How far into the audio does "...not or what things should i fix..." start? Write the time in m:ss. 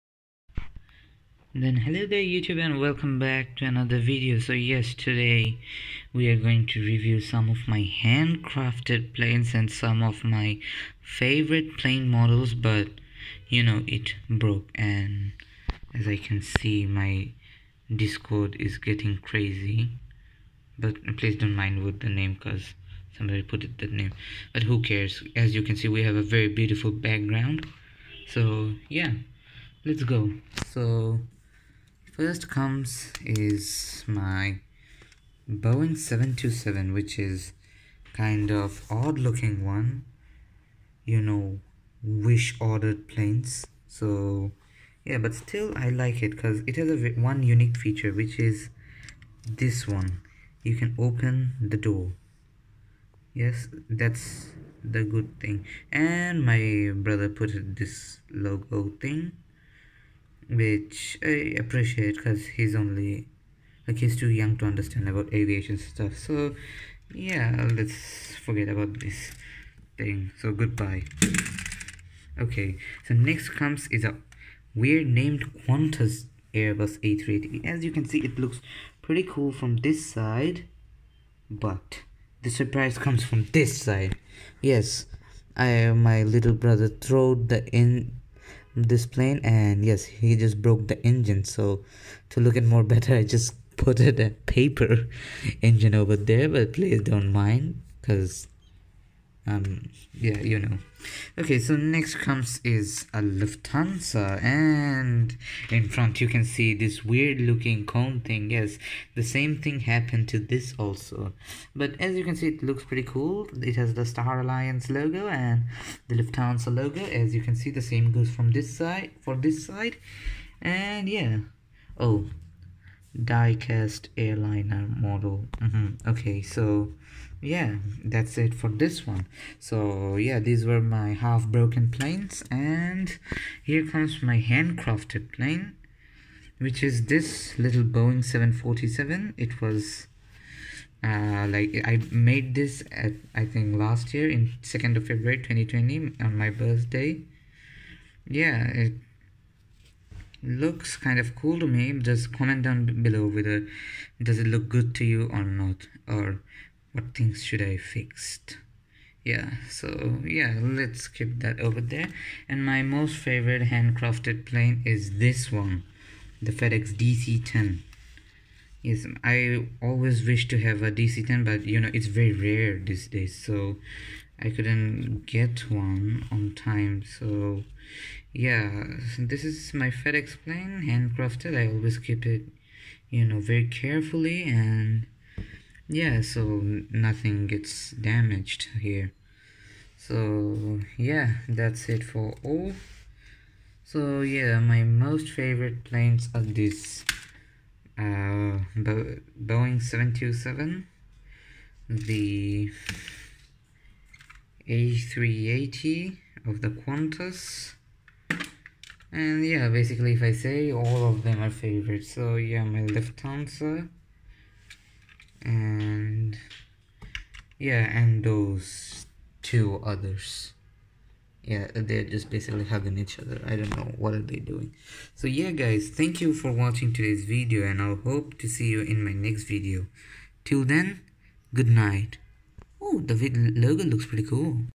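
2:35.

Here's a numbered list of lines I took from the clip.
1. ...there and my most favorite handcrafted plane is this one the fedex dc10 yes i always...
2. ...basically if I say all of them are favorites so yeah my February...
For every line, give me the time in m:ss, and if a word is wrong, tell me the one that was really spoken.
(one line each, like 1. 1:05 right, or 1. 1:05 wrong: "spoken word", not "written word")
1. 2:41 right
2. 3:29 wrong: "Lufthansa", not "February".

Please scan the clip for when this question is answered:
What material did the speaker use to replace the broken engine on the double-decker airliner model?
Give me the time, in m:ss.
1:34.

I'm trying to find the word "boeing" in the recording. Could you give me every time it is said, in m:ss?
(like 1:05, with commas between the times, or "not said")
0:35, 2:17, 3:19.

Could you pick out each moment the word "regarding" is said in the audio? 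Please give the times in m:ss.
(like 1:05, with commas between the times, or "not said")
not said.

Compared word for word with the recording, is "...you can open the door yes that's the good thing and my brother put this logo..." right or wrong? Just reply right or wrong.
right.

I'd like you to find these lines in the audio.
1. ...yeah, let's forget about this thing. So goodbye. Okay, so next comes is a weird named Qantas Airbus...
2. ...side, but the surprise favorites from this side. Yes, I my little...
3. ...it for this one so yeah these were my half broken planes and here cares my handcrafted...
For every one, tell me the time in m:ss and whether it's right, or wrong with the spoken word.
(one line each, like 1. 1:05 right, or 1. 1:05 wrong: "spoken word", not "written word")
1. 1:07 right
2. 1:20 wrong: "comes", not "favorites"
3. 2:08 wrong: "comes", not "cares".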